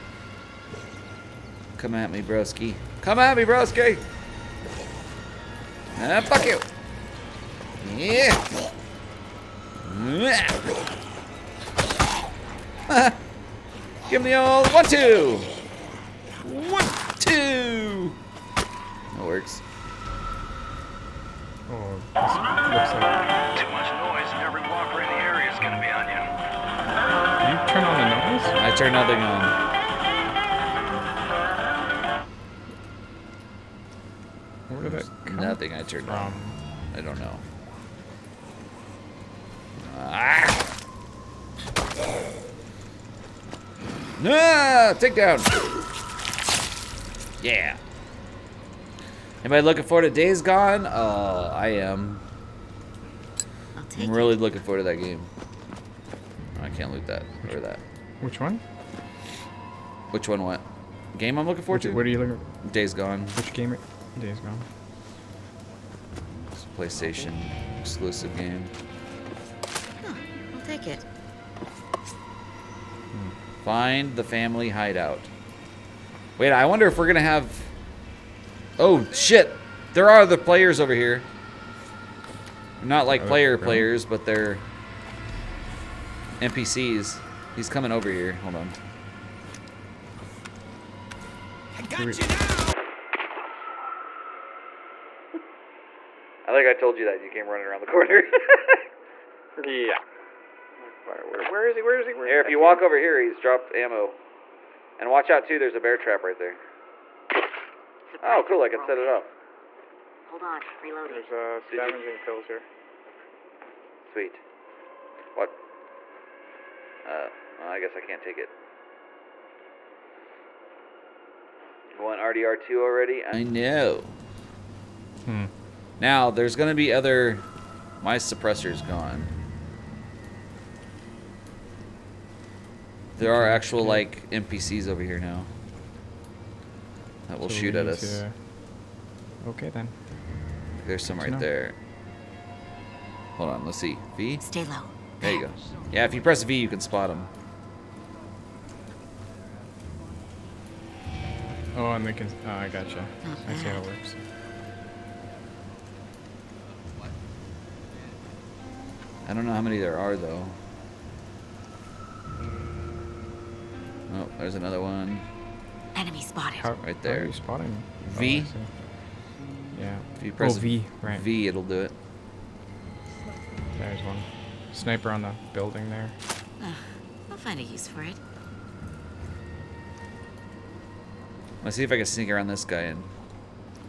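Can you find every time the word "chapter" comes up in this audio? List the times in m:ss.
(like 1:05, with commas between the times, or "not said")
not said.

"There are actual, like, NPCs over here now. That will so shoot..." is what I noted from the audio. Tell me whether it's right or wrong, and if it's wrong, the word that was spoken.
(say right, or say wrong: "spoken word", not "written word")
right.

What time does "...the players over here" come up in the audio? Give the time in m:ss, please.
1:20.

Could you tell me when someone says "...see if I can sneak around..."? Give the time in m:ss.
3:01.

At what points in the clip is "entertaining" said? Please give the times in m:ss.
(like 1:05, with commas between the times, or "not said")
not said.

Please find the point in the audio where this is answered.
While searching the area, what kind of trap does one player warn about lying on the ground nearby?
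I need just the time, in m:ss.
1:45.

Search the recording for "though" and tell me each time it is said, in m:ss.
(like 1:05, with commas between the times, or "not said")
2:40.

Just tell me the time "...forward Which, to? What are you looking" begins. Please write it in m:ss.
1:01.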